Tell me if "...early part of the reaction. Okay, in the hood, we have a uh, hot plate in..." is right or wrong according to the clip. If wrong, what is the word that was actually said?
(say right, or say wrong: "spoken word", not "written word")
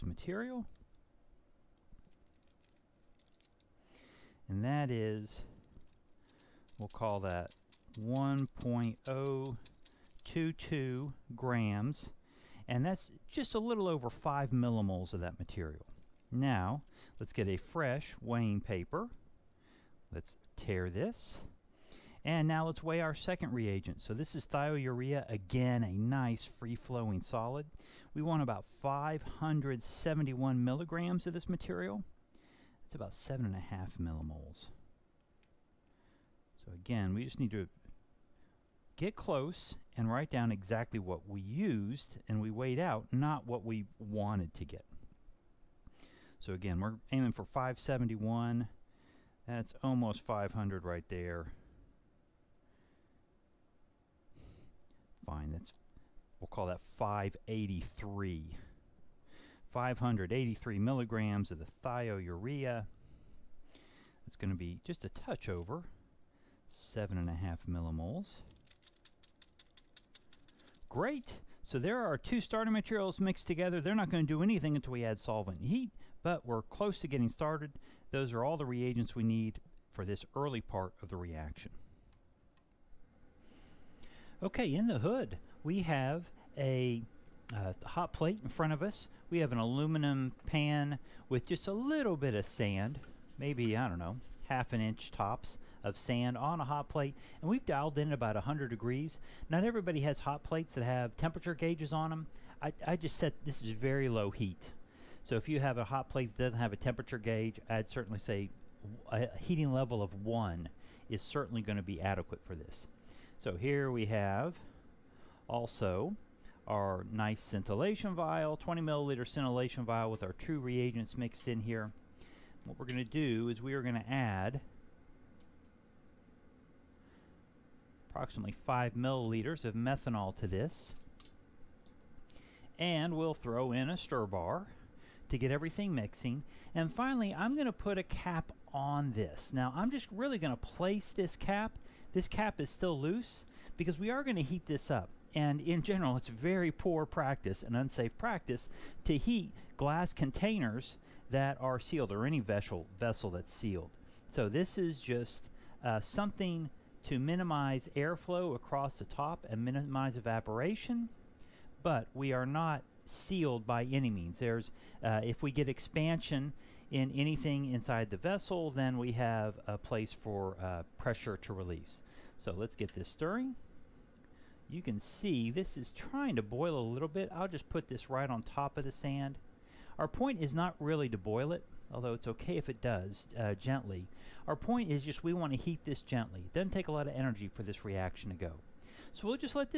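right.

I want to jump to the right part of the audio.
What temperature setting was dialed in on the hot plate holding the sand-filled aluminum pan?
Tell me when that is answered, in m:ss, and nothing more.
1:38.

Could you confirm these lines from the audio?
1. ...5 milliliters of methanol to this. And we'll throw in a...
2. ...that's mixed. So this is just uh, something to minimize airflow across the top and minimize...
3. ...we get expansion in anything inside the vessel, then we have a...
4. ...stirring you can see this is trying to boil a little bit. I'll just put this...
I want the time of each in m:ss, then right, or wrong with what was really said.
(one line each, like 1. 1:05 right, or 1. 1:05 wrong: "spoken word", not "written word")
1. 2:08 right
2. 2:33 wrong: "sealed", not "mixed"
3. 2:45 right
4. 2:53 right.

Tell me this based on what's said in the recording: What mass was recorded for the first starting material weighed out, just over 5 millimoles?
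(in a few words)
1.022 grams.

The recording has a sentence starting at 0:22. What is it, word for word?
And now let's weigh our second reagent.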